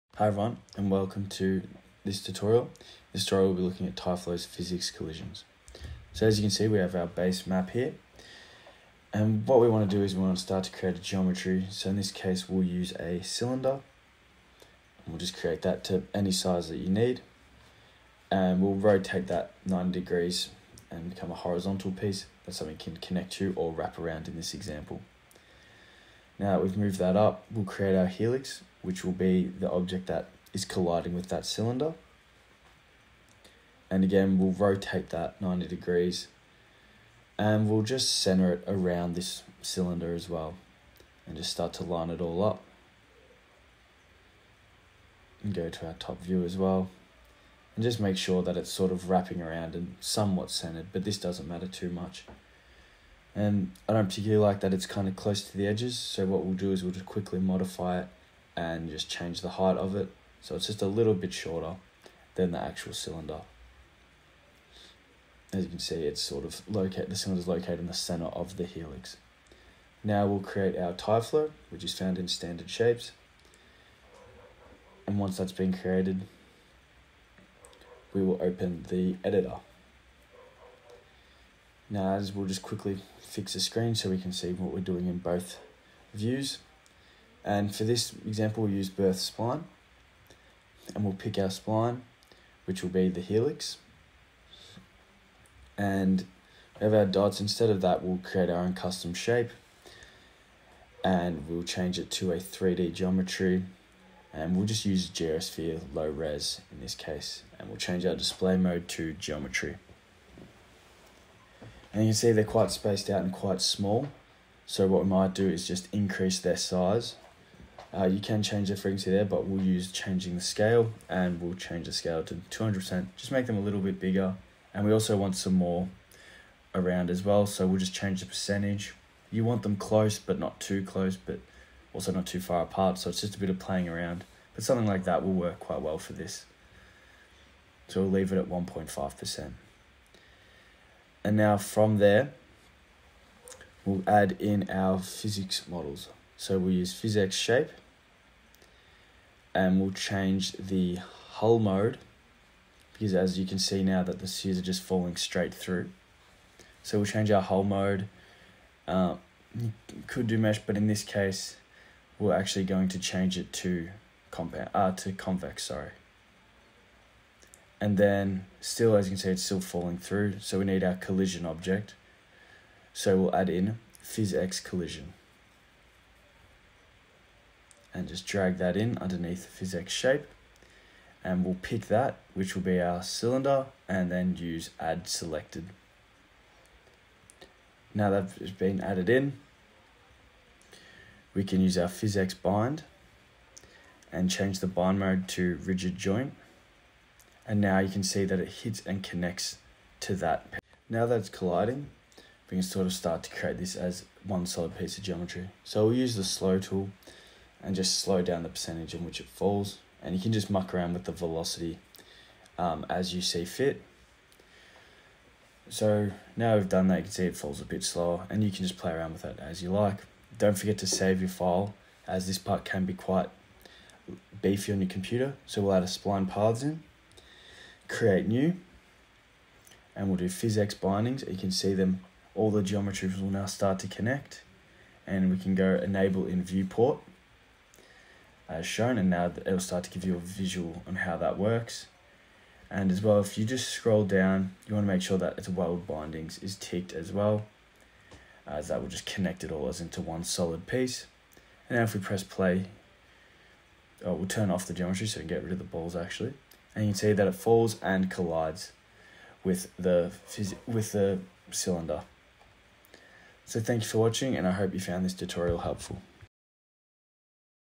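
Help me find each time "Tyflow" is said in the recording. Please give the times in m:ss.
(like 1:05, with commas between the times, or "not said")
0:03, 1:10.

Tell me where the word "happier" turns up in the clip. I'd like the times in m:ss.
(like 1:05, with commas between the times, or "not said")
not said.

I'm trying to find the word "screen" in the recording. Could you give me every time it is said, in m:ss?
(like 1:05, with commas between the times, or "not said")
1:23.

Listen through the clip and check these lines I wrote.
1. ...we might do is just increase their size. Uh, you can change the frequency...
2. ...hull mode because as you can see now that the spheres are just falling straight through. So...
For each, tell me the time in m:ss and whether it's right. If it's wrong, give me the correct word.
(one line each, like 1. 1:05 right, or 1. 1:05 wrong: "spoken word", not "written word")
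1. 1:55 right
2. 2:31 right.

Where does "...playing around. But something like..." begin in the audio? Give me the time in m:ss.
2:13.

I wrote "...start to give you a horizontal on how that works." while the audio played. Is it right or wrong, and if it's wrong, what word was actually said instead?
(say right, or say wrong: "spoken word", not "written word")
wrong: "visual", not "horizontal".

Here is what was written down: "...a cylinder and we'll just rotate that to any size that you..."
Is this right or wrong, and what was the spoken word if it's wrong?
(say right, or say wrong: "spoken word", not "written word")
wrong: "create", not "rotate".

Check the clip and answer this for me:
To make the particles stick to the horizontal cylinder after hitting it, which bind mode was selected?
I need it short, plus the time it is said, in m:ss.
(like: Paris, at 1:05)
rigid joint, at 3:15.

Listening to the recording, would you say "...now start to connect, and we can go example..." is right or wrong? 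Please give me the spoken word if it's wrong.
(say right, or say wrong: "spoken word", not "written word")
wrong: "enable", not "example".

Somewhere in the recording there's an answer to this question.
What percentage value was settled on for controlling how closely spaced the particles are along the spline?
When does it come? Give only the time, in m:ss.
2:18.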